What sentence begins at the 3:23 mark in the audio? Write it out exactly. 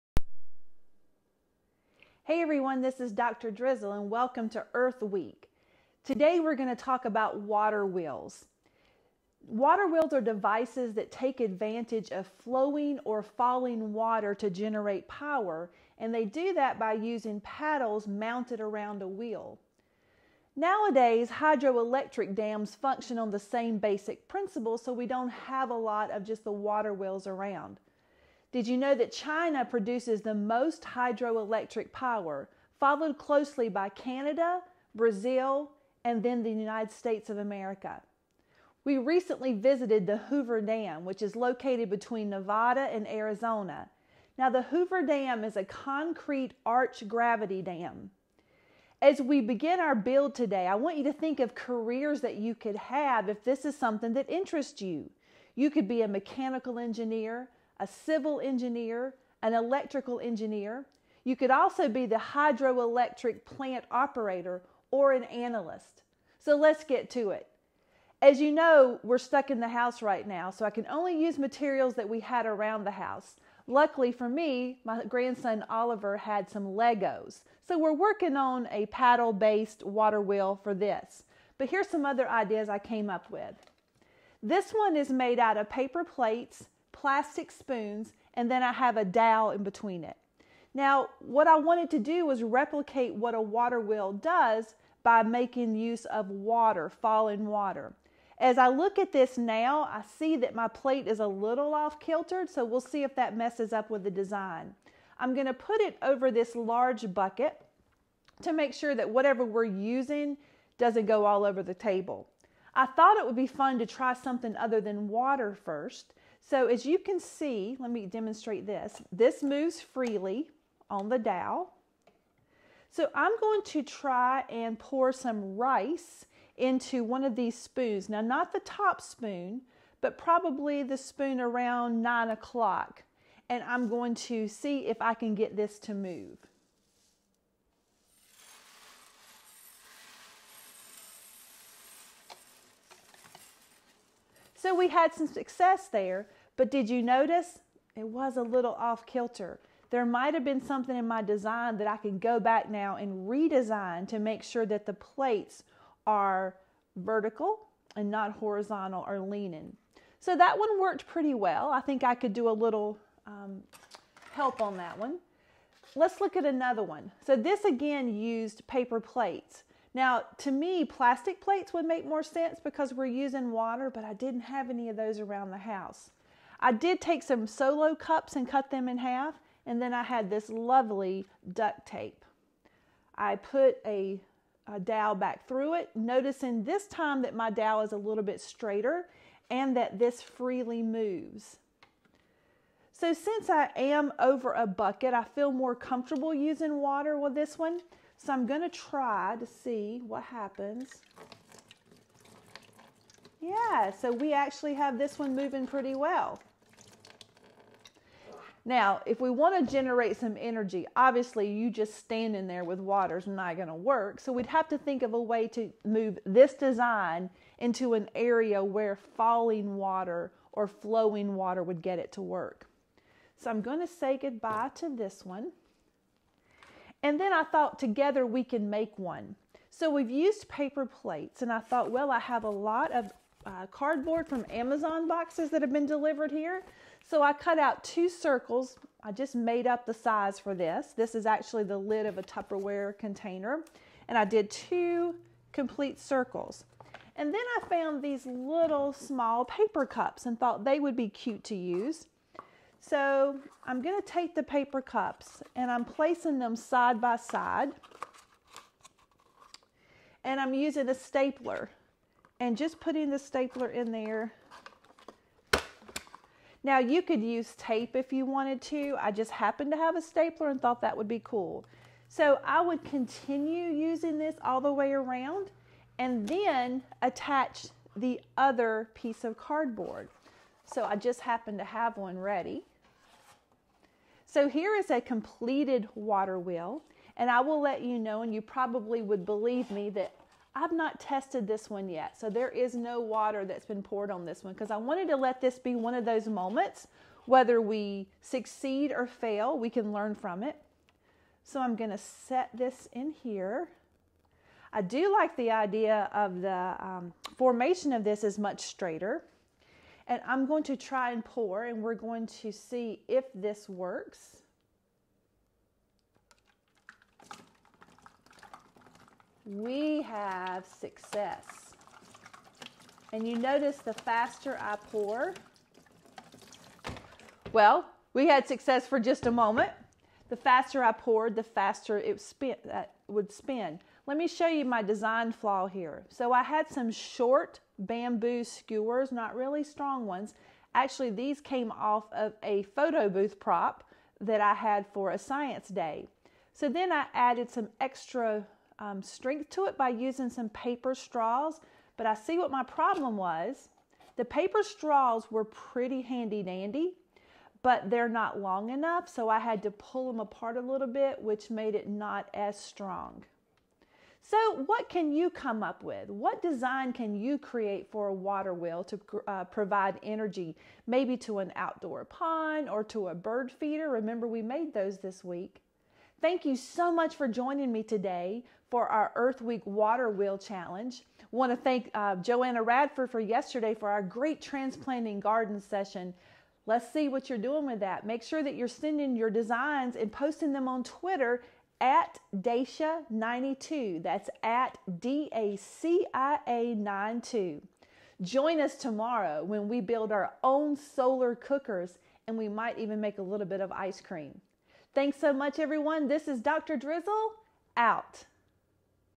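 Yeah, so we actually have this one moving pretty well.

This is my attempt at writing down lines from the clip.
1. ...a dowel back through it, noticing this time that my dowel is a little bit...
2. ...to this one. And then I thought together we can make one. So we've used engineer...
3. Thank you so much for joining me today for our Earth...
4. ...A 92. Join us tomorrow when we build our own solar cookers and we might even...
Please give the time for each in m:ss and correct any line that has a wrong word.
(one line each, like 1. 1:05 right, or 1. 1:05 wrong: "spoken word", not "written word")
1. 3:04 right
2. 3:44 wrong: "paper", not "engineer"
3. 6:16 right
4. 6:36 right.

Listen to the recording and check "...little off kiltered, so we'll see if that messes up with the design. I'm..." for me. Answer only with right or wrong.
right.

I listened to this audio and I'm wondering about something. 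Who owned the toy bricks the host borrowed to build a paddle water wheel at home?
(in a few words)
Oliver.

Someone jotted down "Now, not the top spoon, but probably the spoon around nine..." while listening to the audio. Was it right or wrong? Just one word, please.
right.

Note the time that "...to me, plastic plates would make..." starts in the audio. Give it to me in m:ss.
2:50.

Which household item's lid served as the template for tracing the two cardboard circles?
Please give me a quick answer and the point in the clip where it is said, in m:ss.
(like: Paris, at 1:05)
Tupperware container, at 4:02.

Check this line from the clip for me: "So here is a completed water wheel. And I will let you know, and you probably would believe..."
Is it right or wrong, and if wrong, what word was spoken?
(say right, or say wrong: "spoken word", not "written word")
right.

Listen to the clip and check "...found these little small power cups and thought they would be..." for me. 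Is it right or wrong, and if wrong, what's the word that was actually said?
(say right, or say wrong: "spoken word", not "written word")
wrong: "paper", not "power".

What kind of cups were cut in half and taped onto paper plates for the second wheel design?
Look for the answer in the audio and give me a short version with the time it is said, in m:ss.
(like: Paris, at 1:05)
Solo cups, at 2:57.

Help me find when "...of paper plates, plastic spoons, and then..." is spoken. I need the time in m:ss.
1:25.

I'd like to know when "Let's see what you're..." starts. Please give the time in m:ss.
6:26.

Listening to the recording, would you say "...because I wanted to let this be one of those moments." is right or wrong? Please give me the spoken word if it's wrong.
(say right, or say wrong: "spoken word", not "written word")
right.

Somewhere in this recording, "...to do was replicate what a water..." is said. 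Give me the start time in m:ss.
1:31.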